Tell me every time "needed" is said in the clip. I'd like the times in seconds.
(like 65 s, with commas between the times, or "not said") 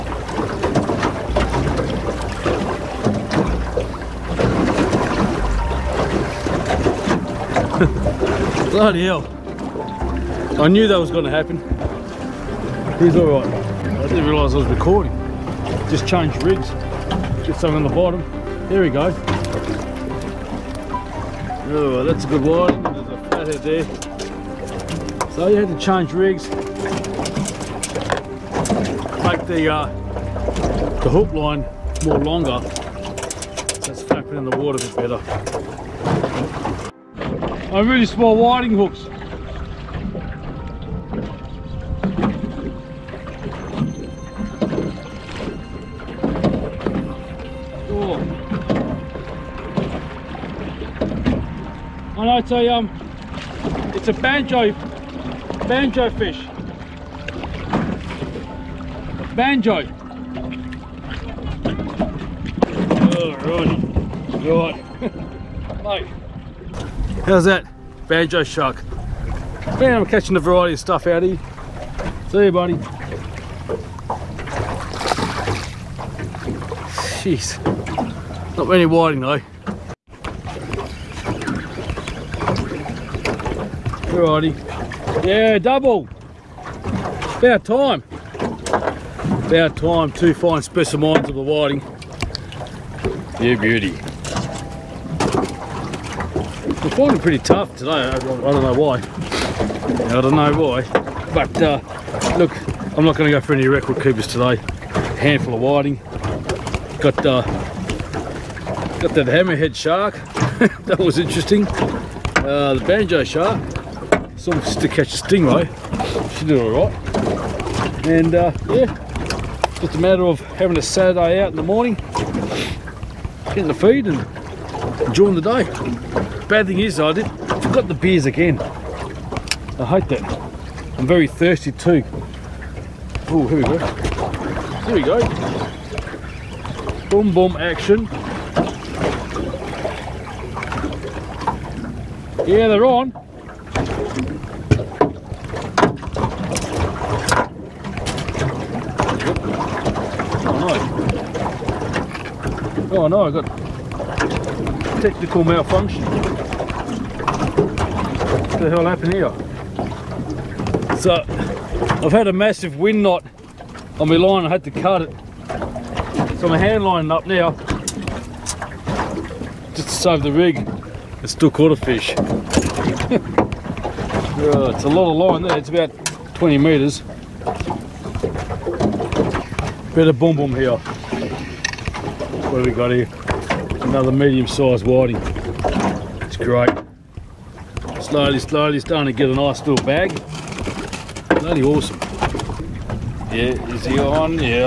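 not said.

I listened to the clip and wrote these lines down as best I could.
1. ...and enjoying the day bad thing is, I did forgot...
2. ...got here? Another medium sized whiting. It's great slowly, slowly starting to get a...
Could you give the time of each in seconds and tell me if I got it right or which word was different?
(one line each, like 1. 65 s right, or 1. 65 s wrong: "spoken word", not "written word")
1. 124 s right
2. 182 s right.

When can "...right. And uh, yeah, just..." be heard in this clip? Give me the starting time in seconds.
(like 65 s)
116 s.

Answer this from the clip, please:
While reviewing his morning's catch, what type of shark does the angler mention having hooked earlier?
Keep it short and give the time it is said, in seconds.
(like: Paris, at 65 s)
hammerhead shark, at 109 s.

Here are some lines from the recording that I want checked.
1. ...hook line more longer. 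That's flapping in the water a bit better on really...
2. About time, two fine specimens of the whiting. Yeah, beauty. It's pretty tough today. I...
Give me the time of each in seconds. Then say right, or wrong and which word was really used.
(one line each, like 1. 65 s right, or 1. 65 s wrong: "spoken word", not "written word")
1. 31 s right
2. 89 s right.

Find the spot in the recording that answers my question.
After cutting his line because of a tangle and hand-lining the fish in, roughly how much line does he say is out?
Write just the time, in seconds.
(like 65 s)
175 s.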